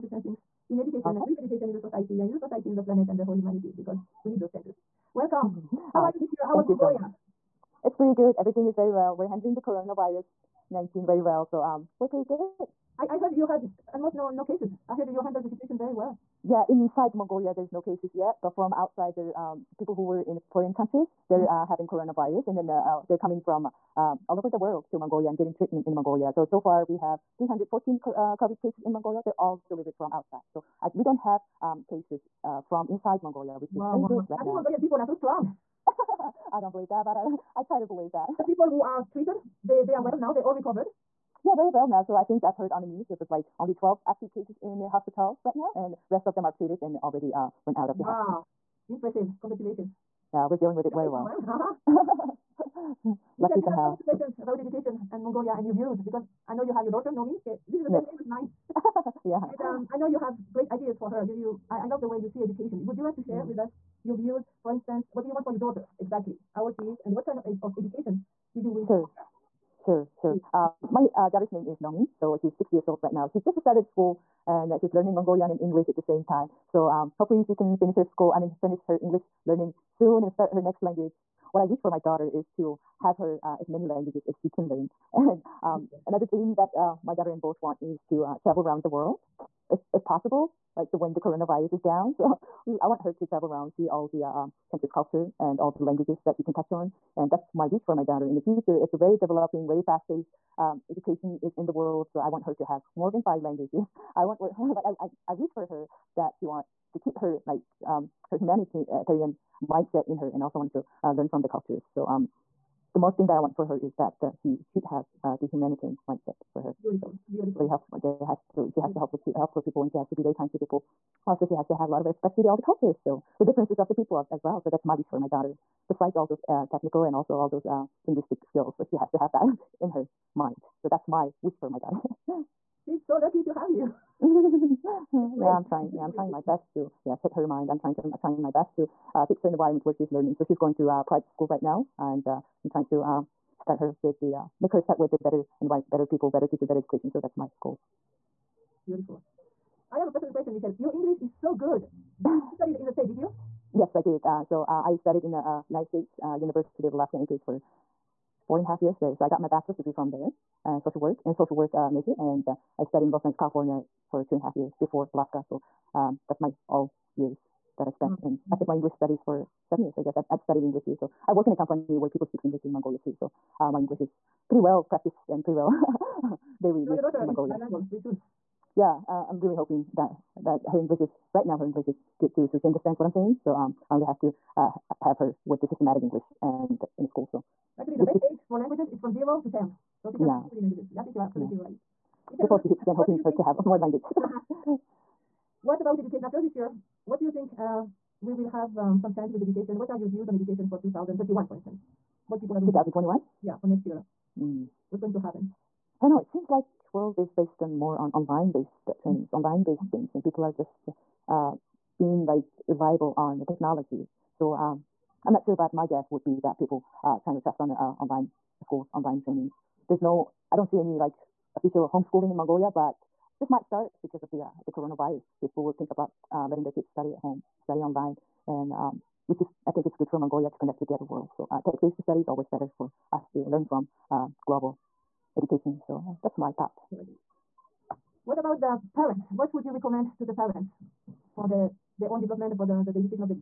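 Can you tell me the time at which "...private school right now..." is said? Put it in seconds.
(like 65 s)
141 s.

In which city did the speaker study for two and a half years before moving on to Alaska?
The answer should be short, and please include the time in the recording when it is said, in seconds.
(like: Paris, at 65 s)
Los Angeles, at 163 s.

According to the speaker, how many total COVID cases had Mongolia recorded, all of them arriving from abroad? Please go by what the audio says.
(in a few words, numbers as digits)
314.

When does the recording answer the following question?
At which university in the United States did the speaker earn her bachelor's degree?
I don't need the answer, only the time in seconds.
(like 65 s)
156 s.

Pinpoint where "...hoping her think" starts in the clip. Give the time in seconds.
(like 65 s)
192 s.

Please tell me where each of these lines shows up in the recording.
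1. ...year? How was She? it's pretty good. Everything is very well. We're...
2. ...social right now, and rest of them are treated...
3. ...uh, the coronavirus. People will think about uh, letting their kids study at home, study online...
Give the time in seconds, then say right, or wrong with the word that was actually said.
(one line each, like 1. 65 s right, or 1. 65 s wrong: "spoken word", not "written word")
1. 6 s wrong: "Mongolia", not "She"
2. 44 s wrong: "hospital", not "social"
3. 224 s right.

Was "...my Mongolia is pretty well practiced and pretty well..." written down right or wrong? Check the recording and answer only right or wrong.
wrong.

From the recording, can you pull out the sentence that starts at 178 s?
Yeah, uh, I'm really hoping that that her English is right now.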